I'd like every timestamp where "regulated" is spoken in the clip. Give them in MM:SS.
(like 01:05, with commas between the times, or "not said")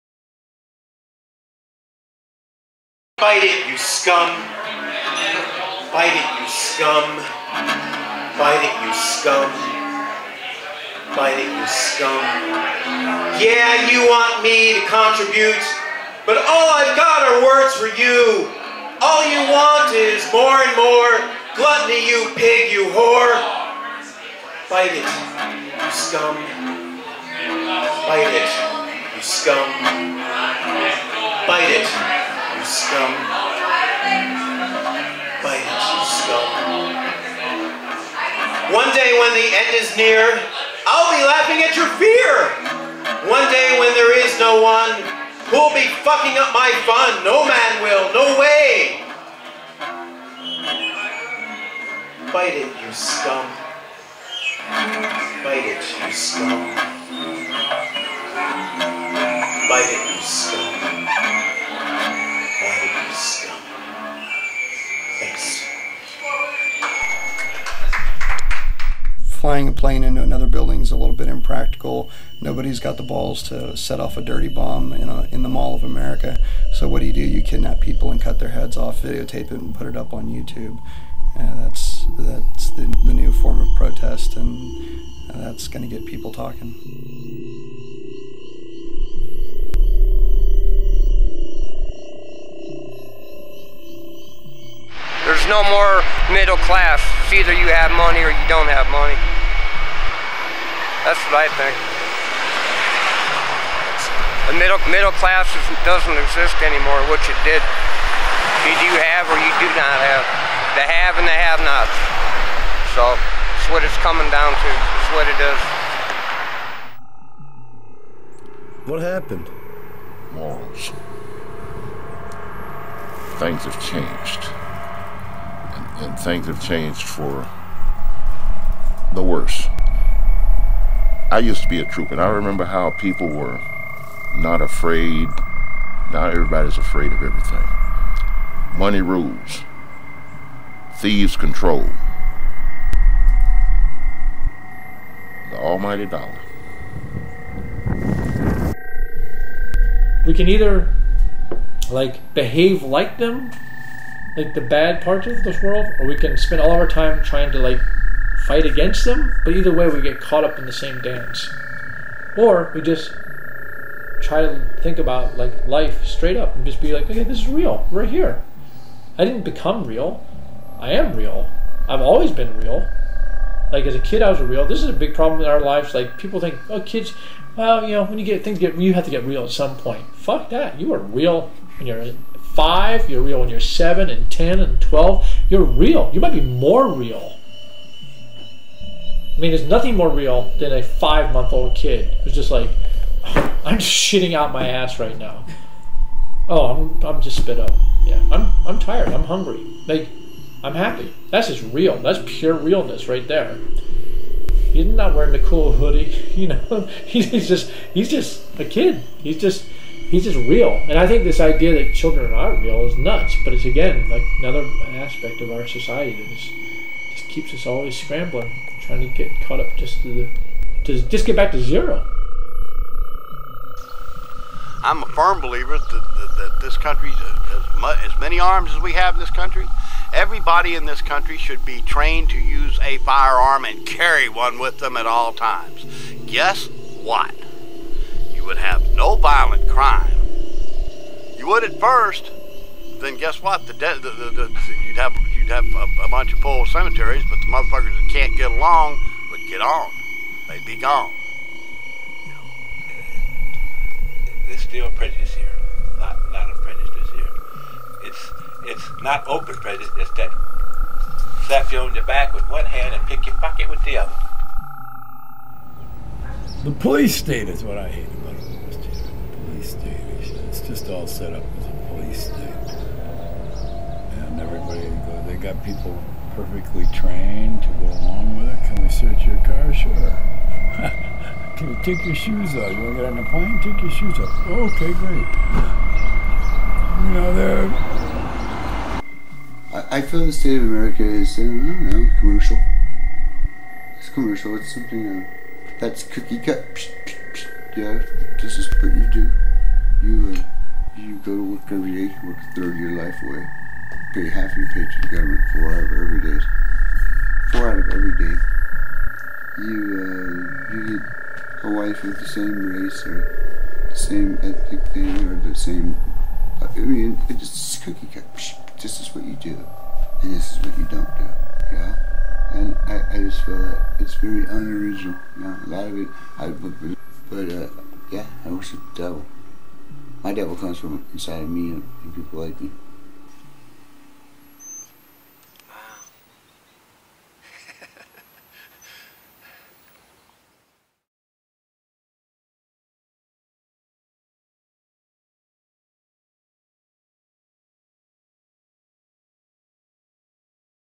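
not said.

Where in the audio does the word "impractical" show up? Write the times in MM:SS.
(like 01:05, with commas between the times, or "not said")
01:11.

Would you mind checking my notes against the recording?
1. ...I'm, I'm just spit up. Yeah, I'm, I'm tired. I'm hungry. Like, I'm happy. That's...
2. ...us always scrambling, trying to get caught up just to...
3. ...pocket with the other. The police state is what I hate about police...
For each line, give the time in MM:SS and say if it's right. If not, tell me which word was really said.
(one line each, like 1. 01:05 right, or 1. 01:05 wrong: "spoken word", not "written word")
1. 03:16 right
2. 03:37 right
3. 04:23 right.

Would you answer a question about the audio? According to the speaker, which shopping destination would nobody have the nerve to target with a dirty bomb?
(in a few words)
Mall of America.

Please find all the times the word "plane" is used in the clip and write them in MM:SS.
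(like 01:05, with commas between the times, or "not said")
01:09, 04:43.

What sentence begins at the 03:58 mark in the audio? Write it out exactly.
You would have no violent crime.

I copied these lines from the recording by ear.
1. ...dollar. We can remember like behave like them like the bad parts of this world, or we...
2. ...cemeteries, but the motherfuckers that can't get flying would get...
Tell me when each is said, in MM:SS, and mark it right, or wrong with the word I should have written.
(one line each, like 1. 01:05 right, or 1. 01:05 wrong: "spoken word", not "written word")
1. 02:26 wrong: "either", not "remember"
2. 04:06 wrong: "along", not "flying".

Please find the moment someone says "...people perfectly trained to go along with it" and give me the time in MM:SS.
04:35.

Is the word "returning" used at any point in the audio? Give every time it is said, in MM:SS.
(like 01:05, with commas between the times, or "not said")
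not said.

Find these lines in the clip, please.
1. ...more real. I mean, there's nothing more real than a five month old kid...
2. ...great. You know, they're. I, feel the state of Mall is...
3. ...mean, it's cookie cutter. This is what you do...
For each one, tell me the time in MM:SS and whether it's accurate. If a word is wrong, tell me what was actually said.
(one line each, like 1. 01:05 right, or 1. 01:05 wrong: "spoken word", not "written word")
1. 03:06 right
2. 04:44 wrong: "America", not "Mall"
3. 05:16 right.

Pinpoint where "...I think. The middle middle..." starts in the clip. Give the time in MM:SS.
01:41.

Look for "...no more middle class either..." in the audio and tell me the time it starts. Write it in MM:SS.
01:35.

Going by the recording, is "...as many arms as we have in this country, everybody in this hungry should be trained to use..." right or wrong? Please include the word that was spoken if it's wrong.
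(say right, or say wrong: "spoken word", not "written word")
wrong: "country", not "hungry".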